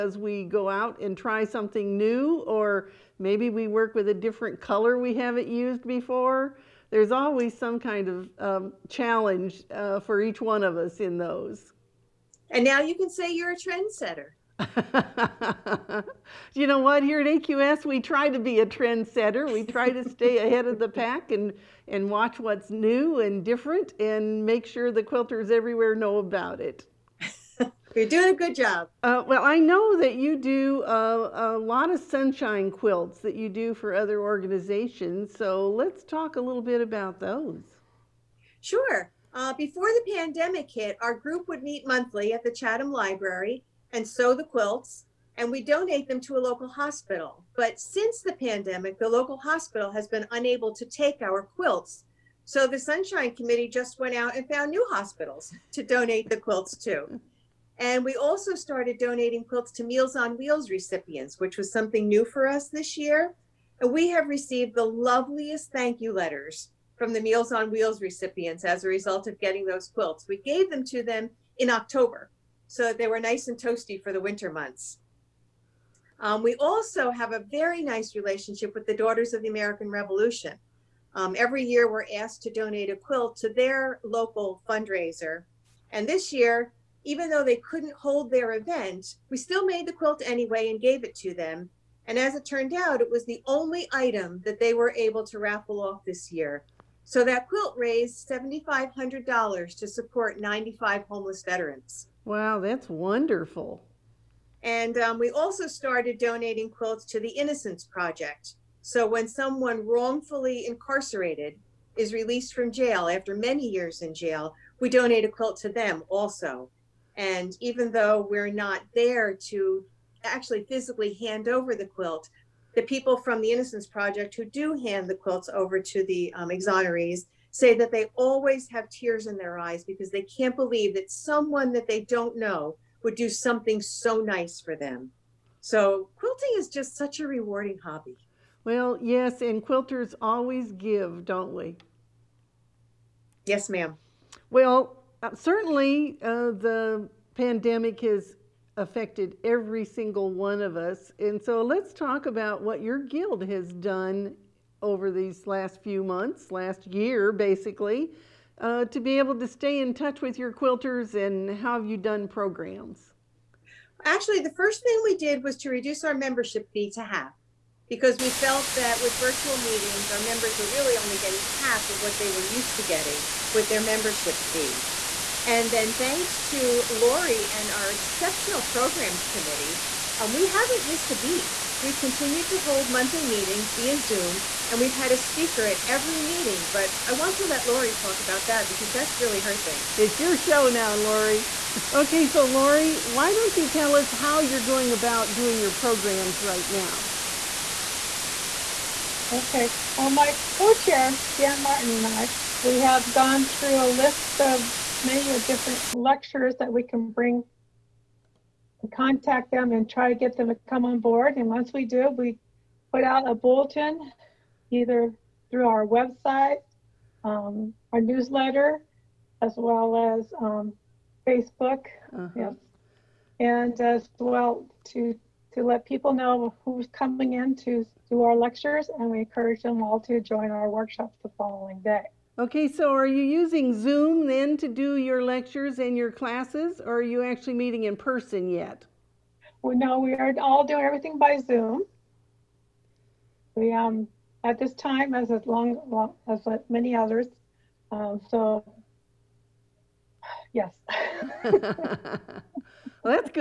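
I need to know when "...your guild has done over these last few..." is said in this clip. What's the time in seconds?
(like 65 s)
152 s.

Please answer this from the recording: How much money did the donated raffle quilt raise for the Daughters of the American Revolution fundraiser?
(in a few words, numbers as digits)
$7,500.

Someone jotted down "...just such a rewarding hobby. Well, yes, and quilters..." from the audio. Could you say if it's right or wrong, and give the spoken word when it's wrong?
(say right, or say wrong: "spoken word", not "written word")
right.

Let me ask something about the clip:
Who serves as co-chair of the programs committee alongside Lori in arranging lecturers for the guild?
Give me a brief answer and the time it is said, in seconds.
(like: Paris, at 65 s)
Jan Martin, at 201 s.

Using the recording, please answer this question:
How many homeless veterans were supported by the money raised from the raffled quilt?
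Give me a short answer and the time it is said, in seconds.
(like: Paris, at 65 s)
95, at 100 s.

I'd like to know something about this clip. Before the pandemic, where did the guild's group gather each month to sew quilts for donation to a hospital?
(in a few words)
Chatham Library.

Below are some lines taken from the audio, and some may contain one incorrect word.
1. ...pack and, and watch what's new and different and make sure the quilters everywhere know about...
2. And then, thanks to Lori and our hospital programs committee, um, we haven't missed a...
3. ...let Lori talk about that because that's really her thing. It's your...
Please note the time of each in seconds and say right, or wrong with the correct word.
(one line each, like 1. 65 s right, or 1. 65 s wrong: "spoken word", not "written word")
1. 20 s right
2. 175 s wrong: "exceptional", not "hospital"
3. 187 s right.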